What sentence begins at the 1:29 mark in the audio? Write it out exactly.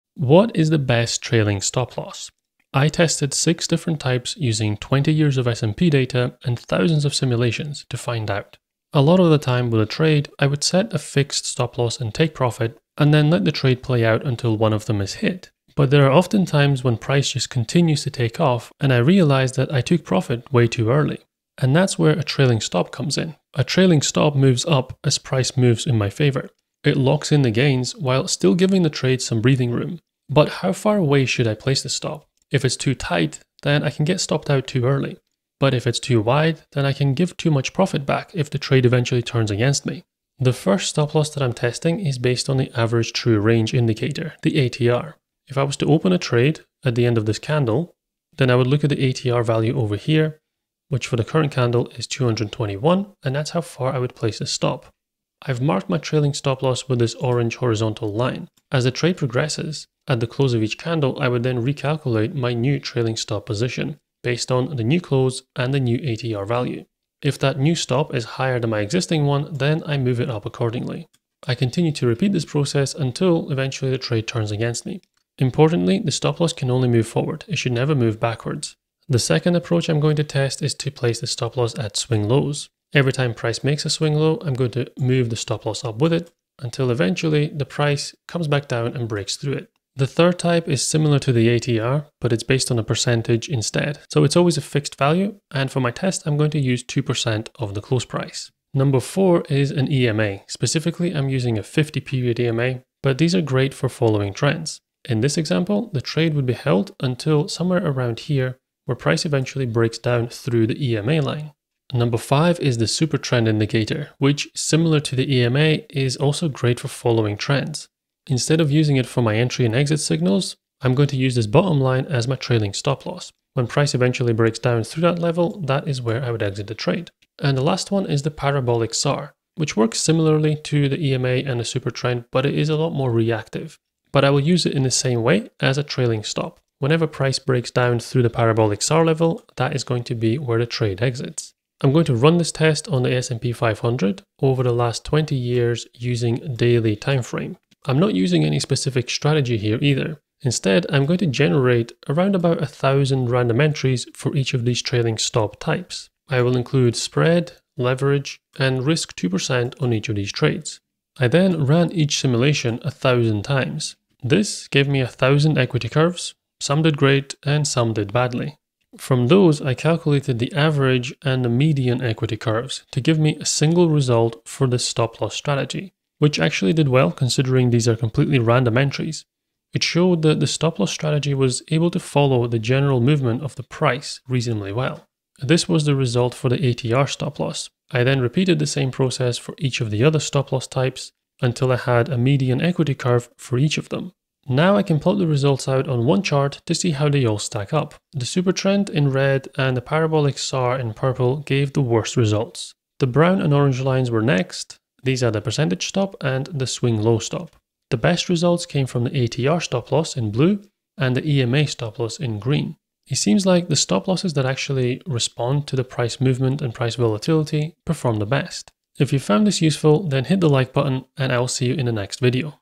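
The third type is similar to the ATR, but it's based on a percentage instead.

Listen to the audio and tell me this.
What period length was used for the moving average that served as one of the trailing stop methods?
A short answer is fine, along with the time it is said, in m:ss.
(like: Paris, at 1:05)
50, at 1:41.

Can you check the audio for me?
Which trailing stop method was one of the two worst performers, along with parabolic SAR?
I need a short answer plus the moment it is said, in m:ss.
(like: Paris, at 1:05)
Supertrend, at 3:18.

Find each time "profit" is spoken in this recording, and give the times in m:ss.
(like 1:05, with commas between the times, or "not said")
0:12, 0:20, 0:37.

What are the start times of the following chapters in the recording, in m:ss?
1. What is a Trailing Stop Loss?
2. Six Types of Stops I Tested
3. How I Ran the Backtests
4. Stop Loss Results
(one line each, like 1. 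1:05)
1. 0:22
2. 0:40
3. 2:20
4. 3:00.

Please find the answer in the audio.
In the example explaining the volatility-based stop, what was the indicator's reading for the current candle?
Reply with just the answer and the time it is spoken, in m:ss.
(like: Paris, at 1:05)
221, at 0:52.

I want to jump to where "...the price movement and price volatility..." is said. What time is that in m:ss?
3:35.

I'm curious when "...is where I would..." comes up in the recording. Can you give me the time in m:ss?
2:05.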